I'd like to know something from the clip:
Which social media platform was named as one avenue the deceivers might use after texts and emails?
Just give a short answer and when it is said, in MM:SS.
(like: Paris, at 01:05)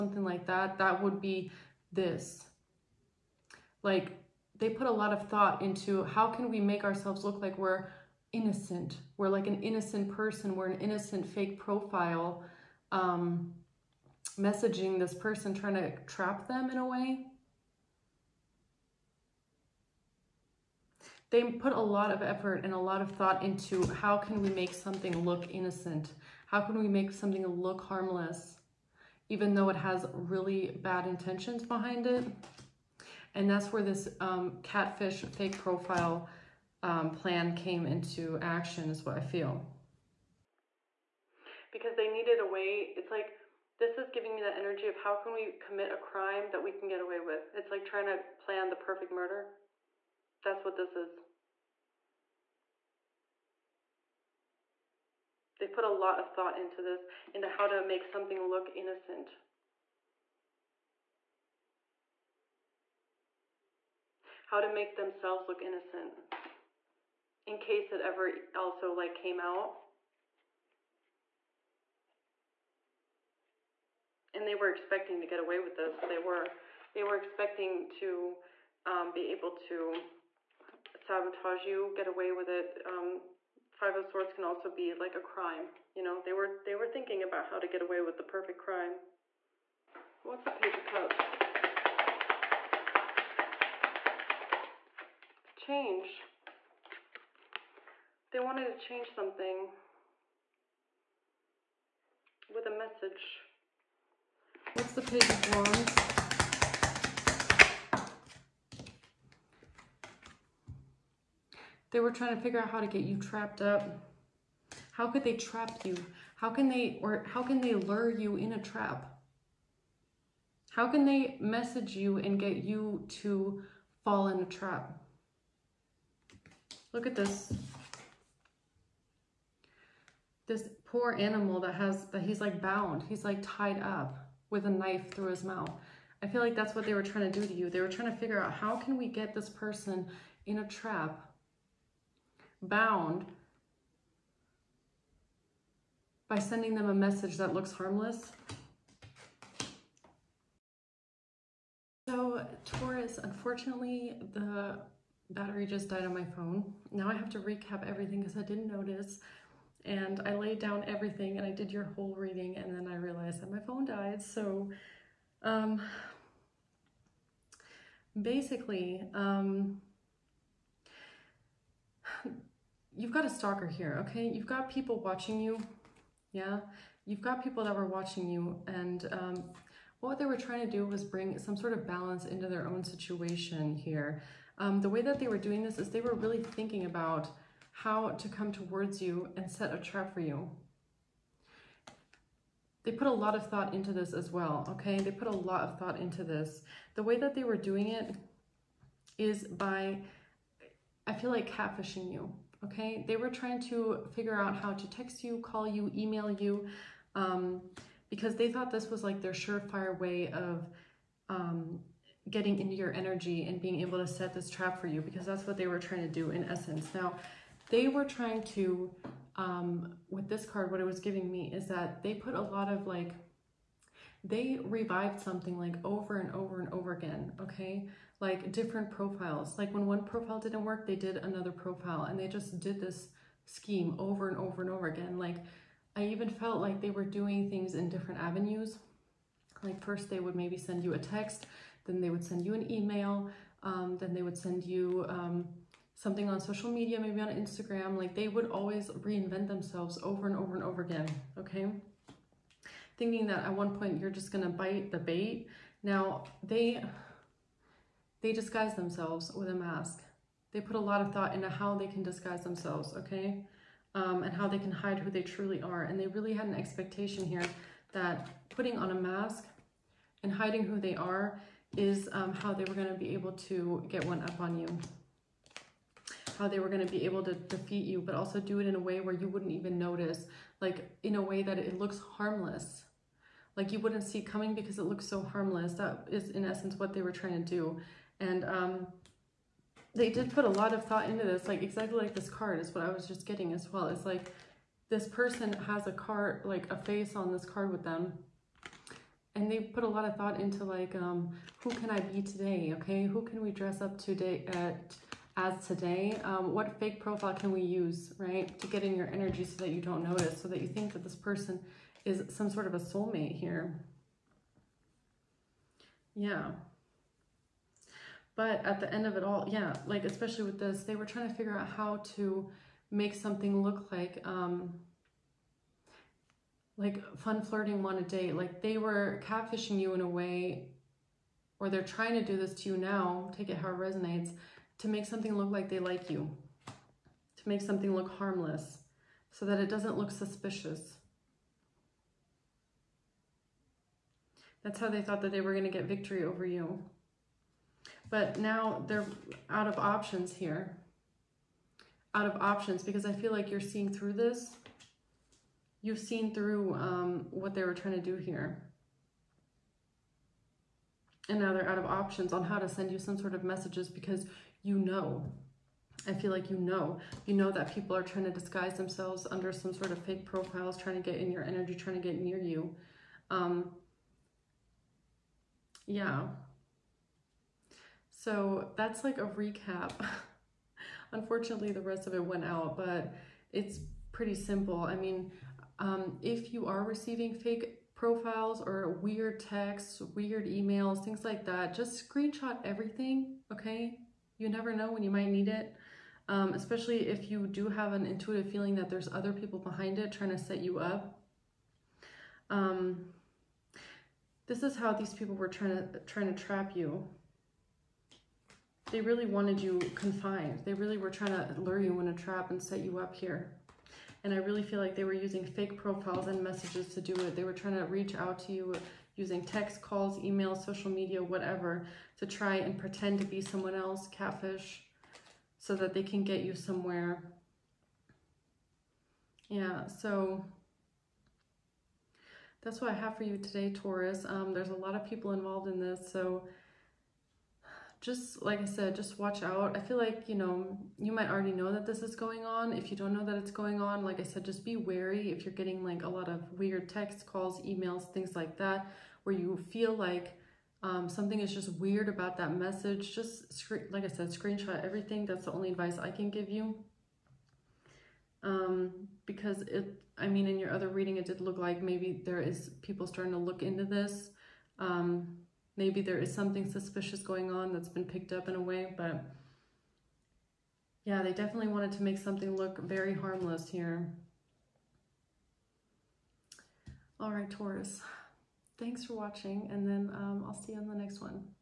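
Instagram, at 04:07.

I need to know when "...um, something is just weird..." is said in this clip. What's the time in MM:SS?
07:30.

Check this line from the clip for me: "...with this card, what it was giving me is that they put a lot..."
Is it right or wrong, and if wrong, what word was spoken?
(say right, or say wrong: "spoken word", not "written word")
right.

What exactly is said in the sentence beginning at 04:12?
Thinking that at one point you're just gonna bite the bait.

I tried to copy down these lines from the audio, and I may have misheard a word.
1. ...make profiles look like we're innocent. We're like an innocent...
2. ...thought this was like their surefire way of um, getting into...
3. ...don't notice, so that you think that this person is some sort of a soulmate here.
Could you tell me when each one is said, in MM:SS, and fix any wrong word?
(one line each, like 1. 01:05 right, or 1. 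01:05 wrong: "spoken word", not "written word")
1. 00:06 wrong: "ourselves", not "profiles"
2. 03:28 right
3. 05:09 right.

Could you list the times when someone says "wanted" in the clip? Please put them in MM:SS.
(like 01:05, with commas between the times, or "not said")
01:38, 06:49, 07:51.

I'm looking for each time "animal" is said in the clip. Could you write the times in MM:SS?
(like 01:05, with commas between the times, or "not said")
02:11.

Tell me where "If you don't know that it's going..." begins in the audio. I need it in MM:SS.
07:22.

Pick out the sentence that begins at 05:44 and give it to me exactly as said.
That's how they thought that they were going to get victory over you.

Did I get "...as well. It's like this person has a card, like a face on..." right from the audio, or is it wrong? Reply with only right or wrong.
right.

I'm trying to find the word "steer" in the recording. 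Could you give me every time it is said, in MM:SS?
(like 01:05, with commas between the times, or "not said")
not said.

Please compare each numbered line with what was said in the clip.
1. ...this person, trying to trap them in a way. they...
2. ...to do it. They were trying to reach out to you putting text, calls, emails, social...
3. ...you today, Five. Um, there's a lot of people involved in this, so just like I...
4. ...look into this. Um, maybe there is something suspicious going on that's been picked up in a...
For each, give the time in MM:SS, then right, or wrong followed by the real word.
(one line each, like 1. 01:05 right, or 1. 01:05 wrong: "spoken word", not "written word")
1. 00:14 right
2. 06:56 wrong: "using", not "putting"
3. 07:13 wrong: "Taurus", not "Five"
4. 07:43 right.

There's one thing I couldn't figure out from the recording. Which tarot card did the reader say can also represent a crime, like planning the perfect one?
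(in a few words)
Five of Swords.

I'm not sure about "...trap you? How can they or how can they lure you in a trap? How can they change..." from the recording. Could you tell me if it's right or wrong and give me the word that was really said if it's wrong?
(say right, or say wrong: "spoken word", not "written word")
wrong: "message", not "change".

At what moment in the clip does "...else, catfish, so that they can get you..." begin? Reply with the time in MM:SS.
07:03.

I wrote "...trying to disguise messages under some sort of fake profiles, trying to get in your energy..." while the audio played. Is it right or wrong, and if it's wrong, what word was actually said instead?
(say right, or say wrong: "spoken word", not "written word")
wrong: "themselves", not "messages".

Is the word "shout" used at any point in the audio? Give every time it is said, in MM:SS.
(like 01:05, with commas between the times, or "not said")
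not said.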